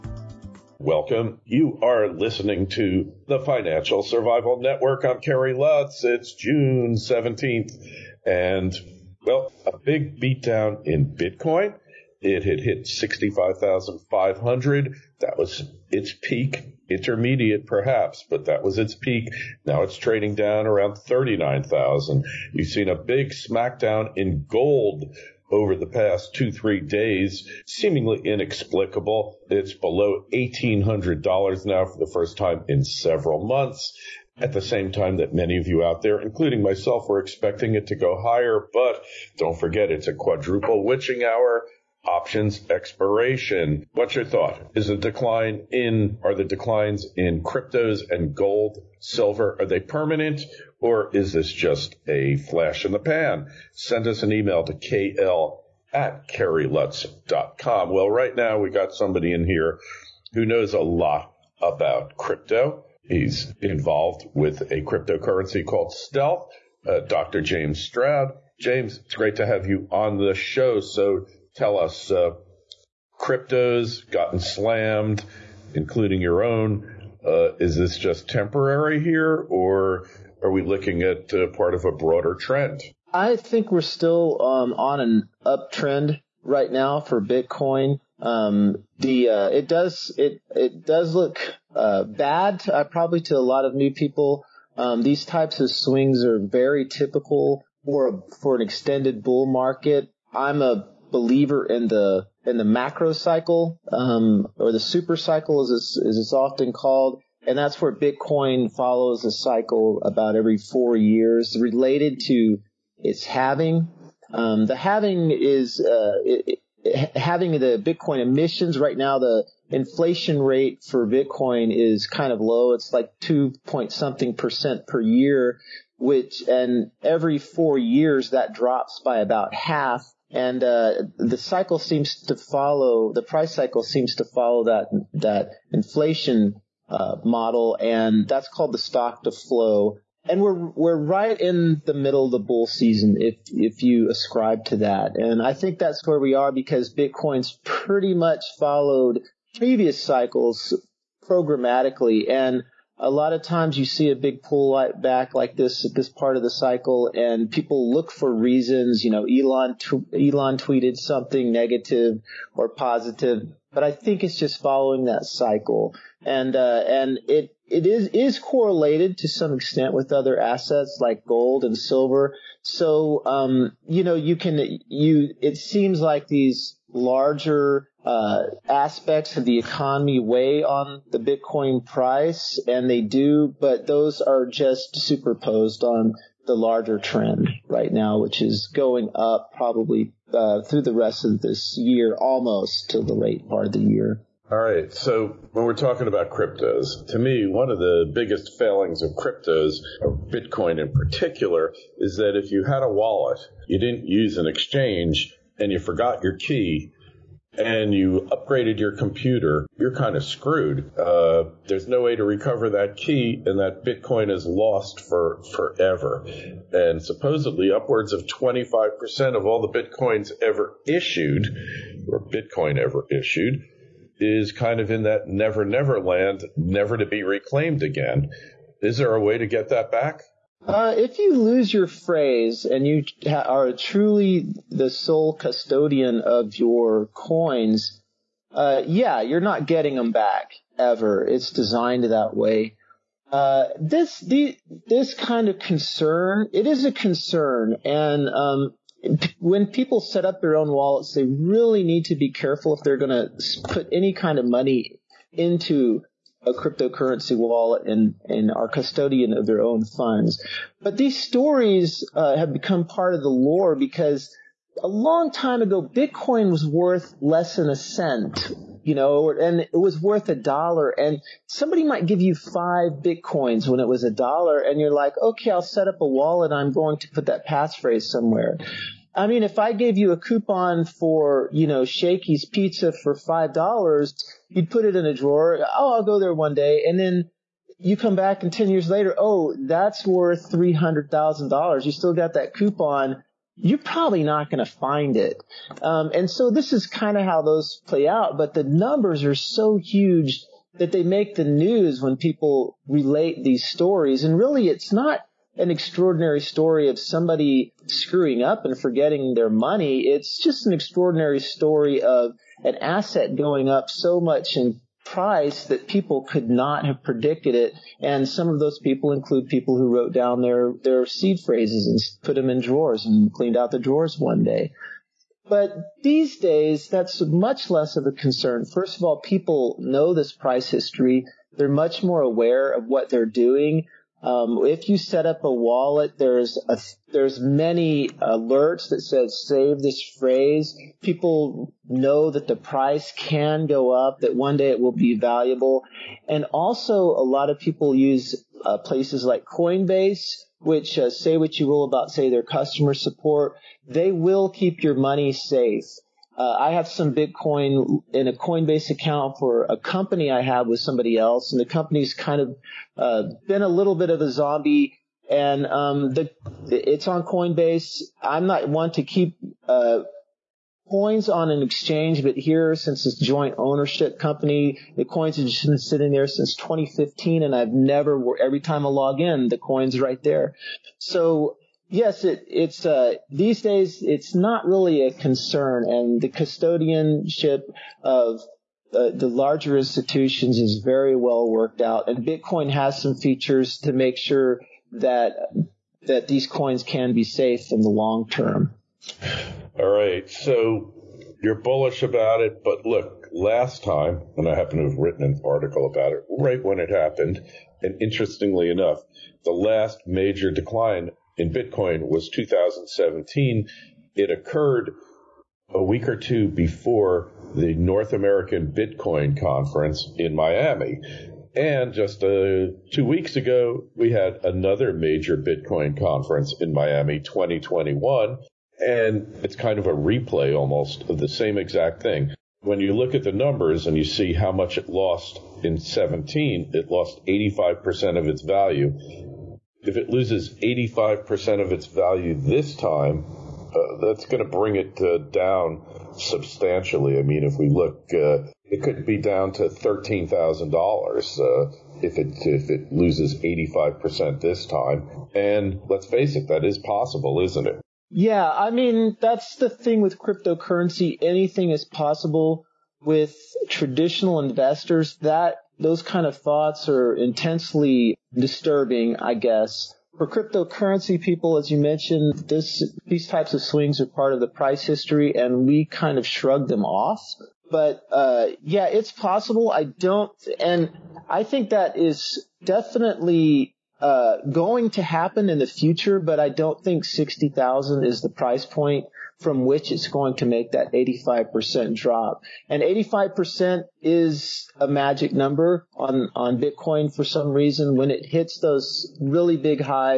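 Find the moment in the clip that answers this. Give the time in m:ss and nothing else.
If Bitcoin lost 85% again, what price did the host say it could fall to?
7:29.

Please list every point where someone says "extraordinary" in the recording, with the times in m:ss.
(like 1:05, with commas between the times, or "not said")
5:05, 5:10.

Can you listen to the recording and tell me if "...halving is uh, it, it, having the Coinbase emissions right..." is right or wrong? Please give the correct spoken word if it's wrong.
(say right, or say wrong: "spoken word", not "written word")
wrong: "Bitcoin", not "Coinbase".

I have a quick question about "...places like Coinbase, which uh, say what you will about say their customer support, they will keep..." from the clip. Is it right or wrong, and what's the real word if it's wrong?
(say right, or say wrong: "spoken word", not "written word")
right.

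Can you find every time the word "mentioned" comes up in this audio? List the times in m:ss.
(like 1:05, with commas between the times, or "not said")
7:51.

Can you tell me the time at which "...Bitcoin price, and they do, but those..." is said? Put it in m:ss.
3:01.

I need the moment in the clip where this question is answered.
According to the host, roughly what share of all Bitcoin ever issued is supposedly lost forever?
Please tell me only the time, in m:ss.
3:38.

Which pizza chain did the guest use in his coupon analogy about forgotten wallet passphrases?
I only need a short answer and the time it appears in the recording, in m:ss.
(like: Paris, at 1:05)
Shakey's Pizza, at 4:41.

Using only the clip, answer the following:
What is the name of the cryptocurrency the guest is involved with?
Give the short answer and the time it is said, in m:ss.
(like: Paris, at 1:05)
Stealth, at 1:05.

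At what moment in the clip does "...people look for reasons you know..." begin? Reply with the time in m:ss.
2:37.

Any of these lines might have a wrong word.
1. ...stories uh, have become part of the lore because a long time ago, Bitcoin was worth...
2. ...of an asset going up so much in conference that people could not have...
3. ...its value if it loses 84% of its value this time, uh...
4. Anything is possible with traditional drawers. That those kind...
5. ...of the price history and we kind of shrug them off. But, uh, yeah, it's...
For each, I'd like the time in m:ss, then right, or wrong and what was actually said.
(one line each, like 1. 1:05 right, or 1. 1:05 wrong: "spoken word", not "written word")
1. 4:21 right
2. 5:12 wrong: "price", not "conference"
3. 7:18 wrong: "85", not "84"
4. 7:41 wrong: "investors", not "drawers"
5. 7:54 right.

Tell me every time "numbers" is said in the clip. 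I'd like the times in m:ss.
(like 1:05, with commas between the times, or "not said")
4:58, 7:13, 8:15.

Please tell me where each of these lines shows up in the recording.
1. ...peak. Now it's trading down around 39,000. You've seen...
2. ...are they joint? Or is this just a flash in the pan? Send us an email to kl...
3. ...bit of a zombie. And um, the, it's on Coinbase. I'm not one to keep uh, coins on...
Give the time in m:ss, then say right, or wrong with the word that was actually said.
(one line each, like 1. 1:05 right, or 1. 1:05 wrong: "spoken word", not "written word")
1. 0:18 right
2. 0:49 wrong: "permanent", not "joint"
3. 6:03 right.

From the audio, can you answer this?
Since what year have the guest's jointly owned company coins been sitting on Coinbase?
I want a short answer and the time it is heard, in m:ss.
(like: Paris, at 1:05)
2015, at 6:16.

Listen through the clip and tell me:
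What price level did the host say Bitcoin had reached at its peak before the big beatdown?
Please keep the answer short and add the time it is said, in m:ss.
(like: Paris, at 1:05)
65,500, at 0:12.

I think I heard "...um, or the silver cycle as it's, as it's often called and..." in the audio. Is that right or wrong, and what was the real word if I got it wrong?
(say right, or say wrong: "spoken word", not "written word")
wrong: "super", not "silver".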